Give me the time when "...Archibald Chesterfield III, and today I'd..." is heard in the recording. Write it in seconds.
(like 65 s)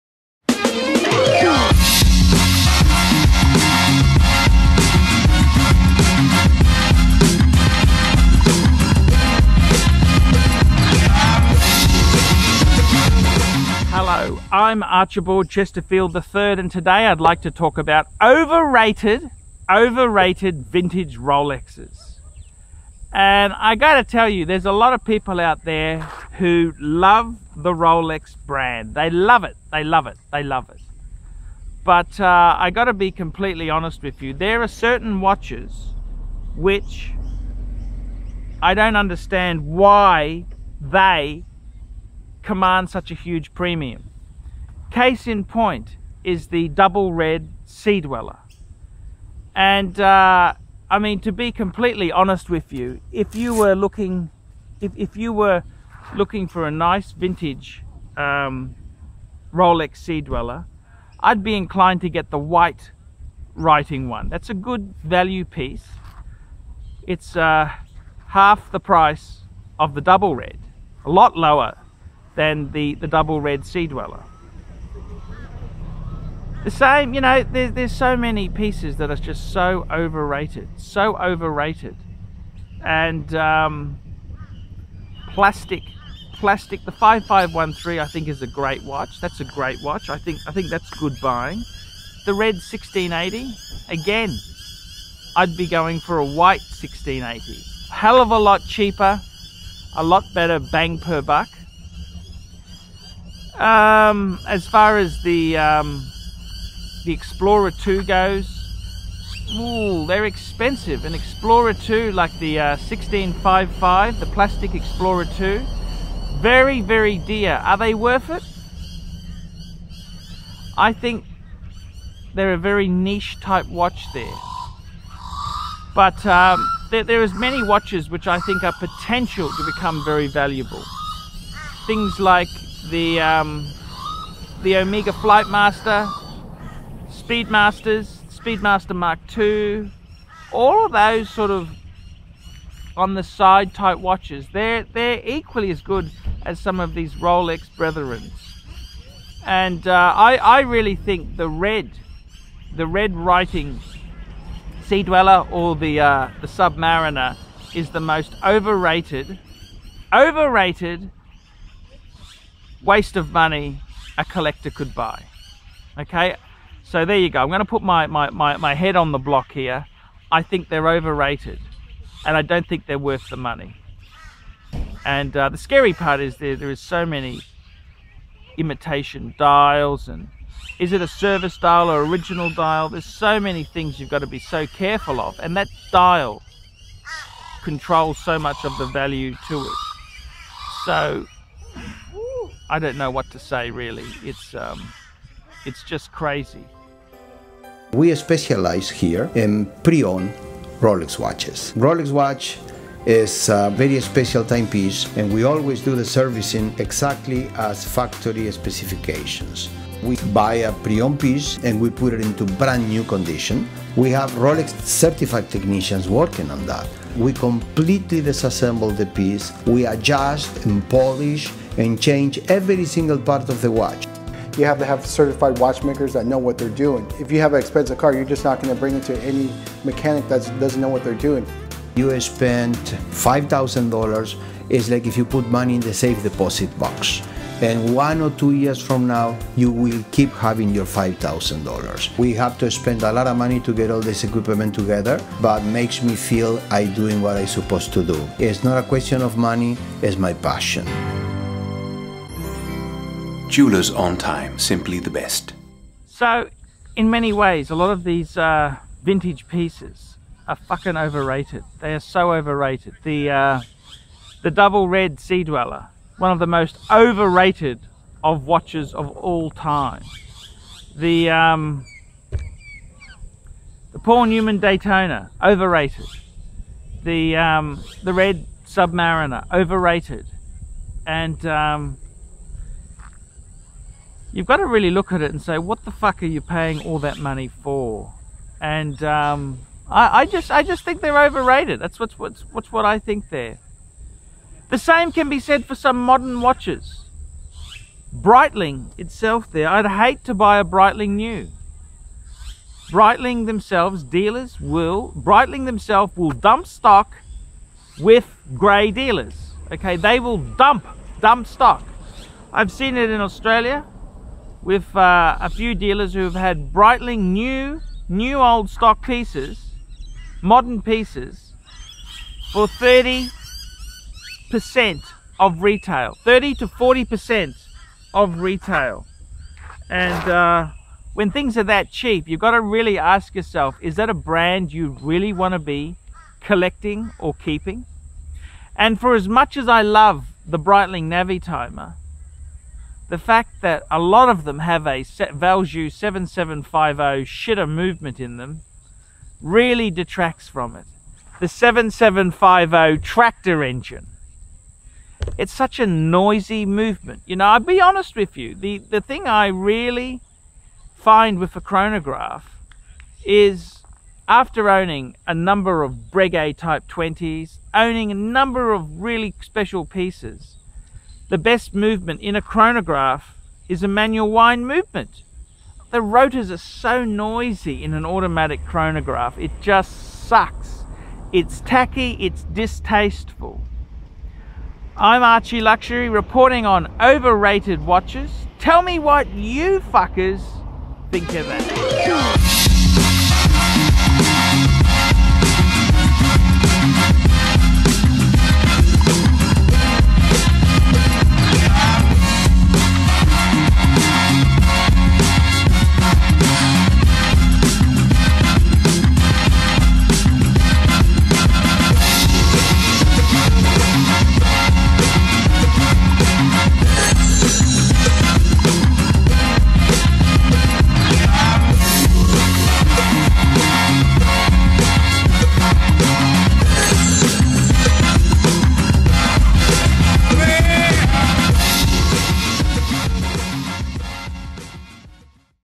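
14 s.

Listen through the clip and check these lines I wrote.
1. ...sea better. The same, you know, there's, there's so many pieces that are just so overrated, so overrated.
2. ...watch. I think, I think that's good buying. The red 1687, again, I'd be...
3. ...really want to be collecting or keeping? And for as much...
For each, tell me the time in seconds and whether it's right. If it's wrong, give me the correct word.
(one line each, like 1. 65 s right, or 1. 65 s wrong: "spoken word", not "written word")
1. 73 s wrong: "dweller", not "better"
2. 89 s wrong: "1680", not "1687"
3. 335 s right.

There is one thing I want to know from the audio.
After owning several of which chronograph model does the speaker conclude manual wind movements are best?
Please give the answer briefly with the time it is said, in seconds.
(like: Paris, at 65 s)
Breguet Type 20, at 366 s.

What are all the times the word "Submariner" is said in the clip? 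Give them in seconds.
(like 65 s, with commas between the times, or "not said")
156 s, 278 s.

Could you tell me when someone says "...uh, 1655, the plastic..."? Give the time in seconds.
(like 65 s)
112 s.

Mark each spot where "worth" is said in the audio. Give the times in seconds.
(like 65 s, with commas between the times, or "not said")
117 s, 172 s.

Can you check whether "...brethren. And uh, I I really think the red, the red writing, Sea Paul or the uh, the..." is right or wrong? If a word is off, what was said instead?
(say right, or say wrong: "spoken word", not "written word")
wrong: "Dweller", not "Paul".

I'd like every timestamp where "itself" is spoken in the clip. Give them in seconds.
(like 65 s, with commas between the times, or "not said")
298 s.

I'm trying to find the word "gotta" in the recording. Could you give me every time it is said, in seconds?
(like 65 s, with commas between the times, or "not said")
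23 s, 32 s.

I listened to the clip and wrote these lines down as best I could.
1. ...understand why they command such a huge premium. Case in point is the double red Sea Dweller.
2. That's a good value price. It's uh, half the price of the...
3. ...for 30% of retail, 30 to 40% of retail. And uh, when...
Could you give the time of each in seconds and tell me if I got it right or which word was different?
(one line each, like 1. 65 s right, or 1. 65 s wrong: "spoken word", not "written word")
1. 38 s right
2. 64 s wrong: "piece", not "price"
3. 322 s right.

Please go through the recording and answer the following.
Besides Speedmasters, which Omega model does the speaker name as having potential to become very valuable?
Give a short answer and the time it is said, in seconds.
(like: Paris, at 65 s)
Flightmaster, at 134 s.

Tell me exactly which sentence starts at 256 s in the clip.
So, in many ways, a lot of these uh, vintage pieces are fucking overrated.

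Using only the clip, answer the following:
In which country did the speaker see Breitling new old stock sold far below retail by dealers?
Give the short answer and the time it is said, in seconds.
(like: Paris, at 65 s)
Australia, at 313 s.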